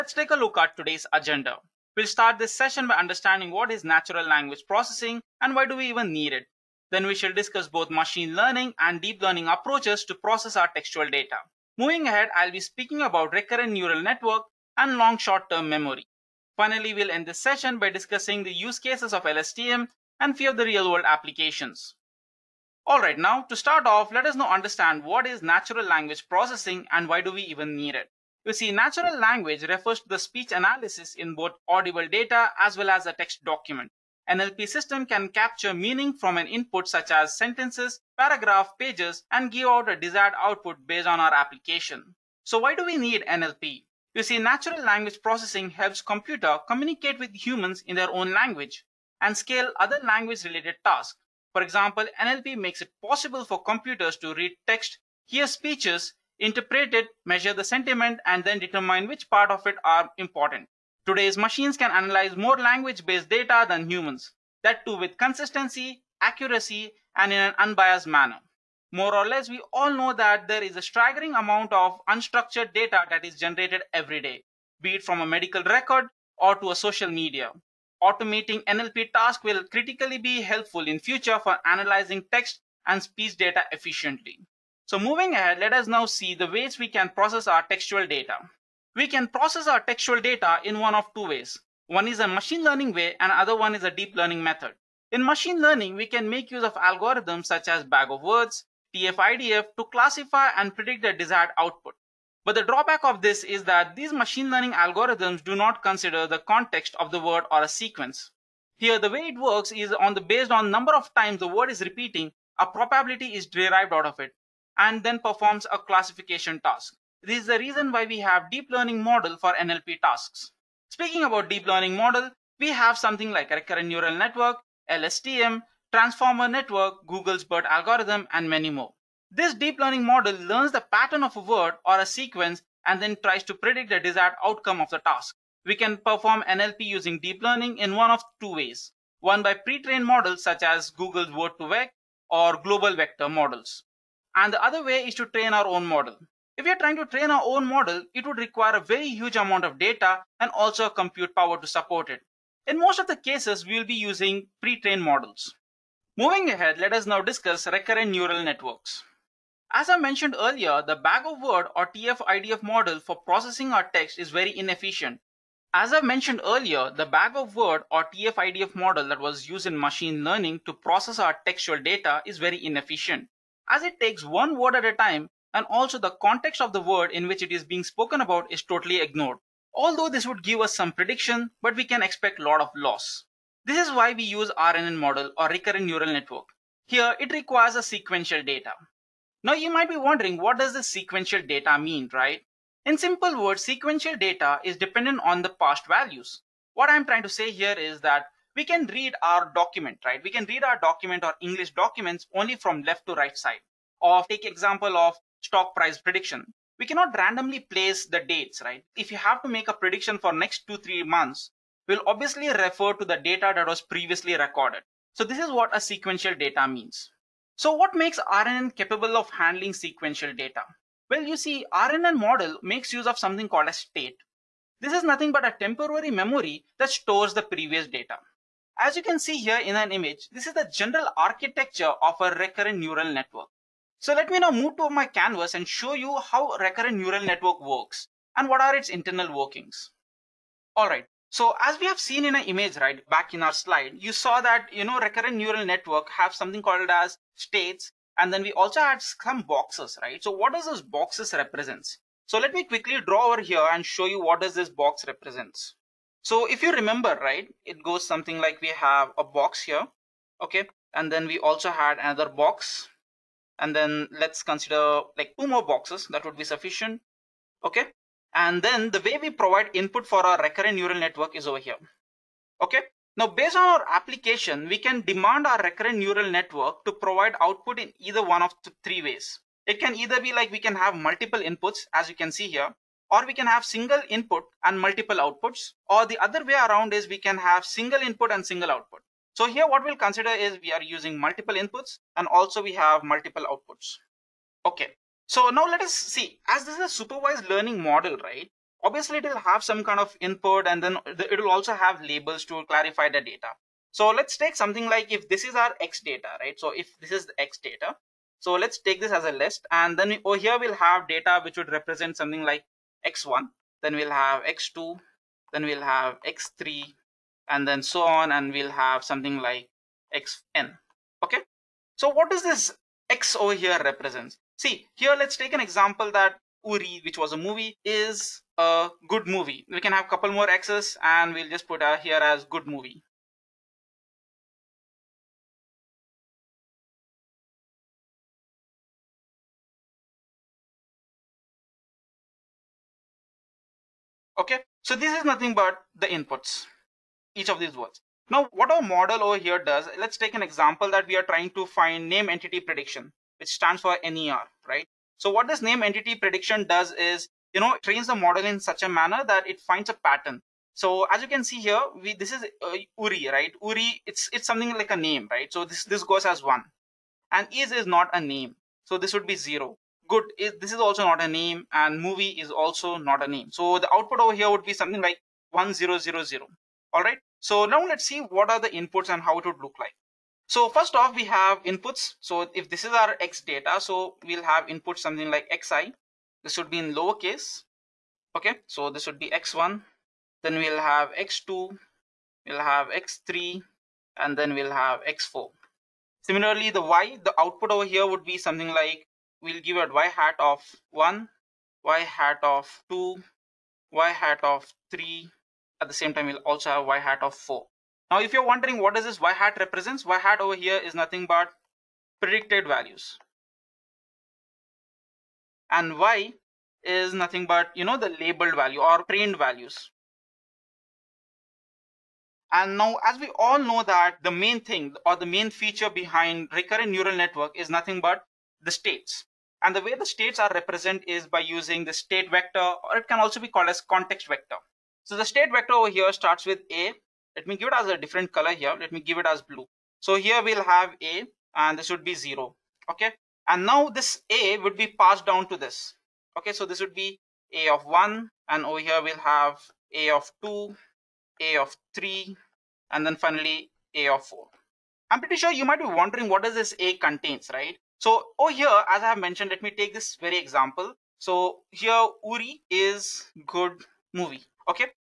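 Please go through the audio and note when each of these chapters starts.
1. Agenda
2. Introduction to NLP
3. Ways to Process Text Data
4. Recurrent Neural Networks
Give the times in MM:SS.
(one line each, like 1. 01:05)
1. 00:16
2. 00:27
3. 01:26
4. 02:37.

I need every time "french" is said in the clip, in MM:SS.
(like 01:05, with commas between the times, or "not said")
not said.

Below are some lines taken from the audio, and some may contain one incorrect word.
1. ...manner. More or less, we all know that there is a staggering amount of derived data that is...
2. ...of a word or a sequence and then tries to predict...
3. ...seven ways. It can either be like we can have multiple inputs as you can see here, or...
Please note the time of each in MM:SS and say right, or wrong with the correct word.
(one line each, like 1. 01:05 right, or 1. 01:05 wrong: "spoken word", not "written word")
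1. 01:08 wrong: "unstructured", not "derived"
2. 02:11 right
3. 04:38 wrong: "three", not "seven".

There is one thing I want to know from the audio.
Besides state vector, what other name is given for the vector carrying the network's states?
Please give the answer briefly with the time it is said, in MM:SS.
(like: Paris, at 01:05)
context vector, at 07:13.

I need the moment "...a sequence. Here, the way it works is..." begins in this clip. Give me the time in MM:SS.
01:47.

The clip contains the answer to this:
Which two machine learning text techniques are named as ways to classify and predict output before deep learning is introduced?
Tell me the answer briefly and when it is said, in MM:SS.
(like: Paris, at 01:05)
bag of words, TF-IDF, at 01:37.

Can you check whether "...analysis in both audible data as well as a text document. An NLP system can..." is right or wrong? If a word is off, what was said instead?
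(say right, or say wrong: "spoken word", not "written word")
right.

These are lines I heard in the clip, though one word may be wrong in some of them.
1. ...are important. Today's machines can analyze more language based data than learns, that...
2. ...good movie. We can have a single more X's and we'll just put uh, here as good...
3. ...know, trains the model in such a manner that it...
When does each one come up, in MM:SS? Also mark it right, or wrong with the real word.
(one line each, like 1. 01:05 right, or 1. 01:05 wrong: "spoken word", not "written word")
1. 00:59 wrong: "humans", not "learns"
2. 05:29 wrong: "couple", not "single"
3. 05:57 right.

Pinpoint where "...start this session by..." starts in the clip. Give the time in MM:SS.
00:02.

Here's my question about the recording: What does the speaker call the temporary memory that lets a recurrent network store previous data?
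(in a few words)
a state.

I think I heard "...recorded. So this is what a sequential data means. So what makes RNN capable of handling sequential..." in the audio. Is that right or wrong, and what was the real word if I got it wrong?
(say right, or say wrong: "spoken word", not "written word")
right.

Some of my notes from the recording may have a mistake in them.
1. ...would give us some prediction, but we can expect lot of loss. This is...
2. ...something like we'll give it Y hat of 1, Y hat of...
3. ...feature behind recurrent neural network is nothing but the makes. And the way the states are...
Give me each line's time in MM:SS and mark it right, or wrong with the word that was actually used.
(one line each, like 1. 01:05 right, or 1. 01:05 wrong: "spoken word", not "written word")
1. 03:00 right
2. 06:38 right
3. 07:05 wrong: "states", not "makes".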